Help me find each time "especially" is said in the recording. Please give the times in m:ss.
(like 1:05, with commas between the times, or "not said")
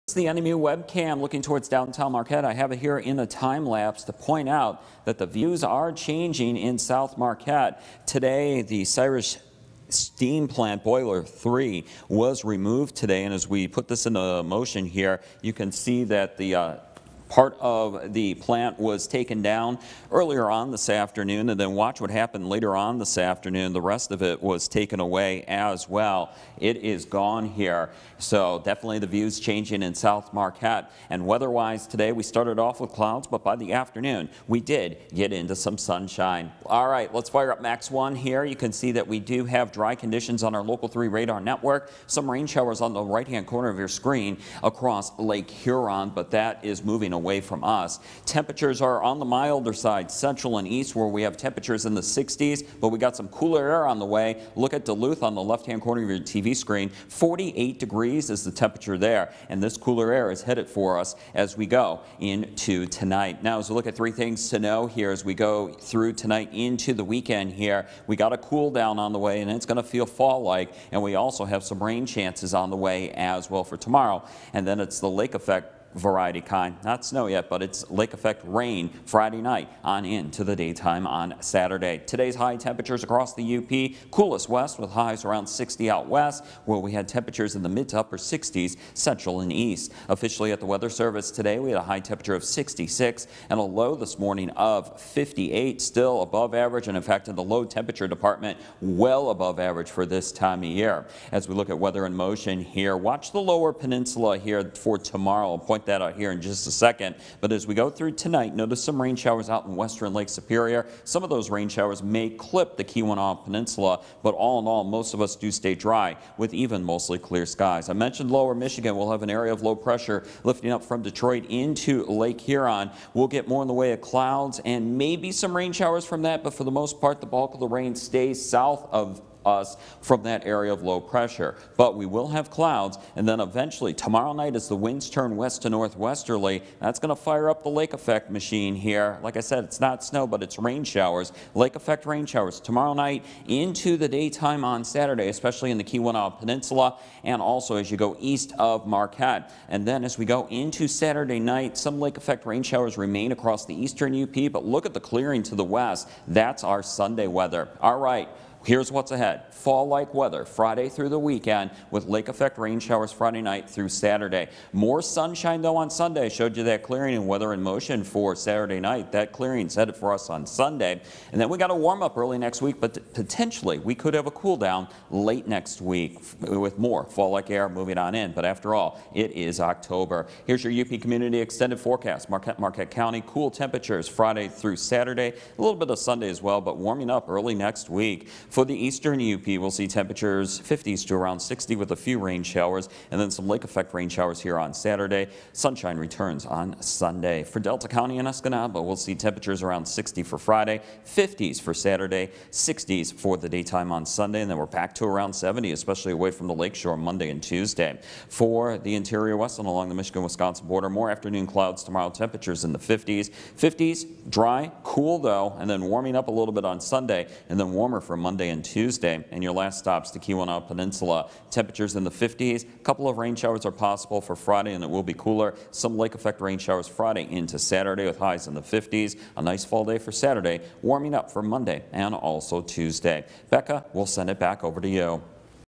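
2:25, 3:25.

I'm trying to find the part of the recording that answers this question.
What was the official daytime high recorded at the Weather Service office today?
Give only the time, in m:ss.
1:32.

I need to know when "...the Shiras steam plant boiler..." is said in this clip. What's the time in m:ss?
0:08.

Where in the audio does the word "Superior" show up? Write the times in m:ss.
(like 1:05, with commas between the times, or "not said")
1:50.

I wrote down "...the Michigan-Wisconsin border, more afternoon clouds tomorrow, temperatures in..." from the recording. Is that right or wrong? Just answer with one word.
right.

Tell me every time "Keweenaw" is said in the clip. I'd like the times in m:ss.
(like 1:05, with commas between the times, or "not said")
1:52, 2:25, 3:40.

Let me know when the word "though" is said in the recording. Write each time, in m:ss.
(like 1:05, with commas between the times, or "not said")
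2:45, 3:35.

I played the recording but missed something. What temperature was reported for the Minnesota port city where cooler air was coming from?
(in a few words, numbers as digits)
48 degrees.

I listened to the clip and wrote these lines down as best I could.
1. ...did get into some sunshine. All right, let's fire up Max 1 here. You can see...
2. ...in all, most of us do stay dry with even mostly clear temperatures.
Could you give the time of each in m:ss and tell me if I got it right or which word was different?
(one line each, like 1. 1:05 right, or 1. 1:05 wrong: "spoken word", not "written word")
1. 0:34 right
2. 1:54 wrong: "skies", not "temperatures".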